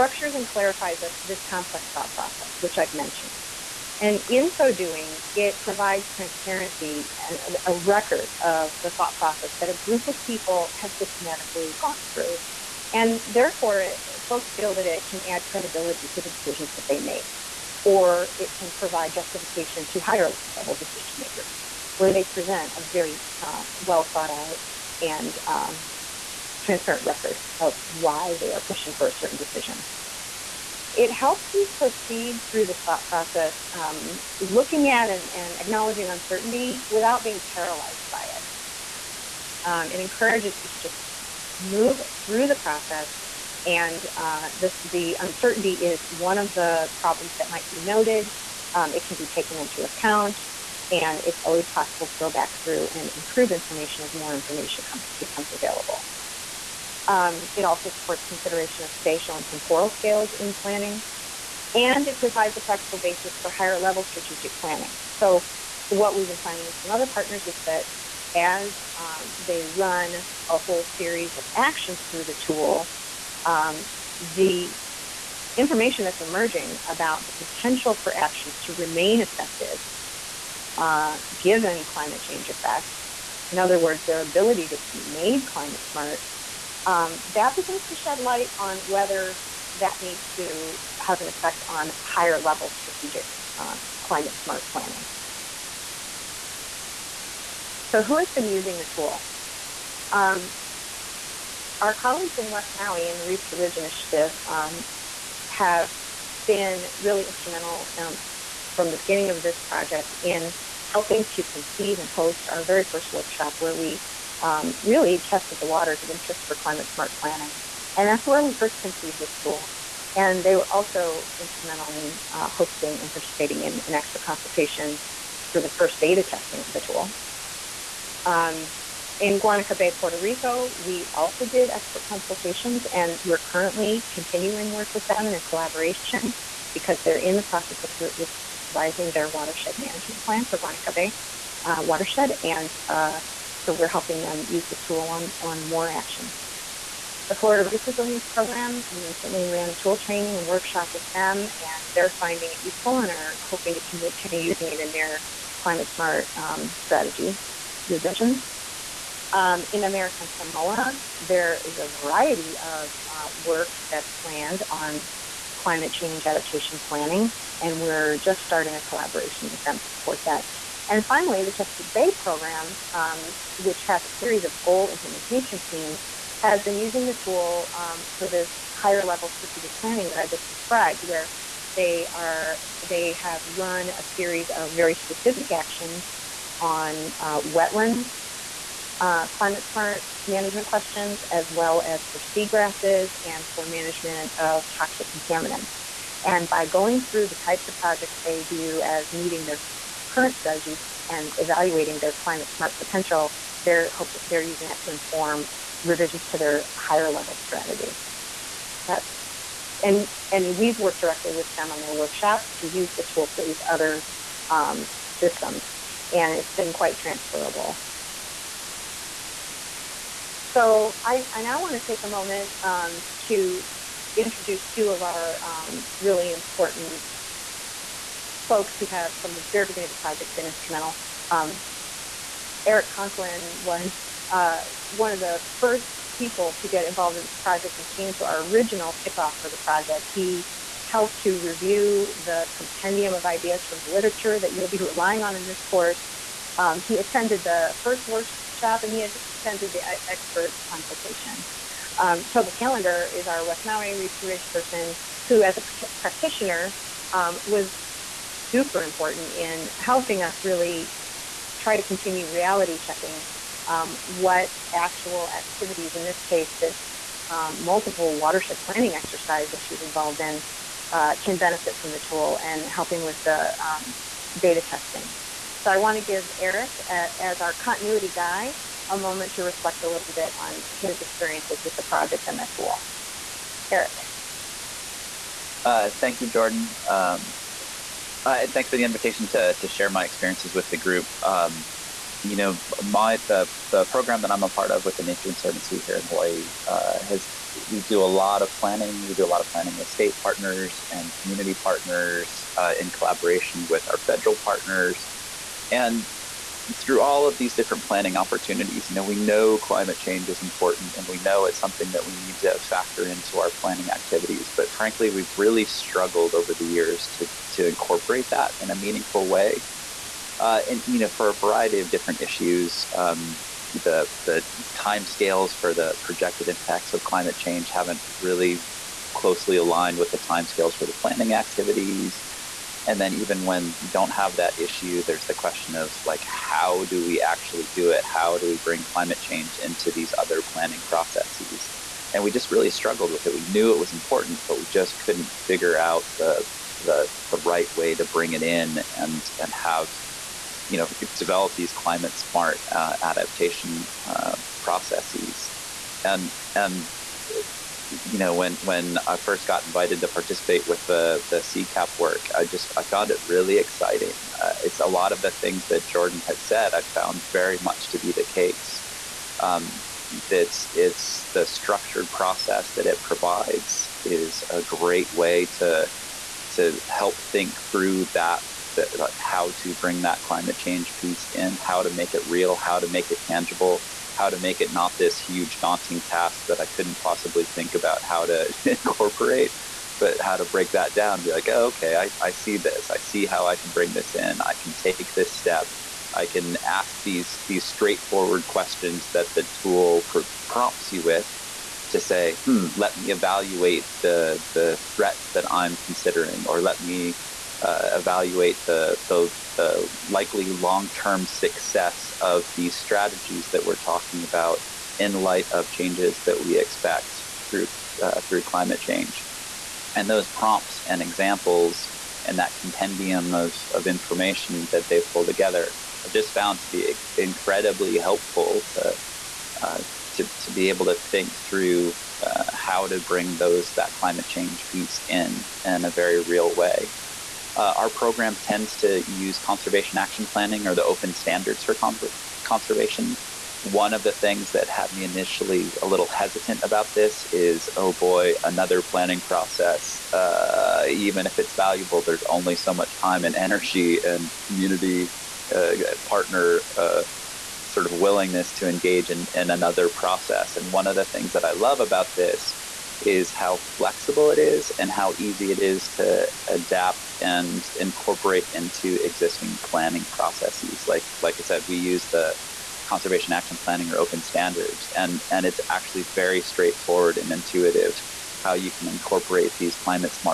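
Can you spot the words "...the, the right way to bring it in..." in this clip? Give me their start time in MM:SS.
05:46.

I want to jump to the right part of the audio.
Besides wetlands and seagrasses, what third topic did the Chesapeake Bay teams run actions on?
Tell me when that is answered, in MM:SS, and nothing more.
03:14.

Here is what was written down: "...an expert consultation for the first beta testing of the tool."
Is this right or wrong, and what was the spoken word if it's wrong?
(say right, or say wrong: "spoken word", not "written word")
right.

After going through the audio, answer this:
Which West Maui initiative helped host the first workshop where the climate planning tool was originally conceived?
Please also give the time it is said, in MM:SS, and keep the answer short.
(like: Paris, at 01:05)
Reef to Ridge Initiative, at 01:43.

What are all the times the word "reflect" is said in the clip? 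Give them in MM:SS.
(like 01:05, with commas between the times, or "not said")
04:39.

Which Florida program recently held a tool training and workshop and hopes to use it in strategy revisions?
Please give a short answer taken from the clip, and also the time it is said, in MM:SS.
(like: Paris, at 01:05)
Florida Reef Resilience Program, at 02:27.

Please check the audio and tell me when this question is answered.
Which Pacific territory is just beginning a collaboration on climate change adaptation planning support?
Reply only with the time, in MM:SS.
02:39.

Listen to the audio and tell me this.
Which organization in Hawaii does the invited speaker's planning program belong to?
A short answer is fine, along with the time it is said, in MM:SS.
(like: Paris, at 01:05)
The Nature Conservancy, at 04:55.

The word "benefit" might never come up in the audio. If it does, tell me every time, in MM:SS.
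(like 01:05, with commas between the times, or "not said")
04:31.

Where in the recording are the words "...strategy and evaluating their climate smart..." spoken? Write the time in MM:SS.
03:20.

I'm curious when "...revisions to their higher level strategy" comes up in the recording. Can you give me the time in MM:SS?
03:25.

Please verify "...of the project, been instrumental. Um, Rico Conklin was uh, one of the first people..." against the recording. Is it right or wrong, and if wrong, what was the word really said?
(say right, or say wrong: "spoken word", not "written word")
wrong: "Eric", not "Rico".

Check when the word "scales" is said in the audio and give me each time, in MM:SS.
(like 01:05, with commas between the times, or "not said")
00:59, 05:25, 05:30.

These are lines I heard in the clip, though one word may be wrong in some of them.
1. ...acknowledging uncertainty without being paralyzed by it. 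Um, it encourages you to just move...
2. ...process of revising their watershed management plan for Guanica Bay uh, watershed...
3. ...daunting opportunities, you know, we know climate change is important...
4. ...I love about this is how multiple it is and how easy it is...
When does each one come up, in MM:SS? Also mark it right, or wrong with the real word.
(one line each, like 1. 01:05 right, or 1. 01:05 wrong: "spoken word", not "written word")
1. 00:35 right
2. 02:17 right
3. 05:07 wrong: "planning", not "daunting"
4. 07:41 wrong: "flexible", not "multiple".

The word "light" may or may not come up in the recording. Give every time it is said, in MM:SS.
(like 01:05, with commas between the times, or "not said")
01:28, 06:55.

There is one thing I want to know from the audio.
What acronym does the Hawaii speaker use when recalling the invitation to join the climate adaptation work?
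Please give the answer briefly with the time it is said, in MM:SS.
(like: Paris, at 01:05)
CCAP, at 06:01.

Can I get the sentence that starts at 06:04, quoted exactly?
Uh, it's a lot of the things that Jordan has said.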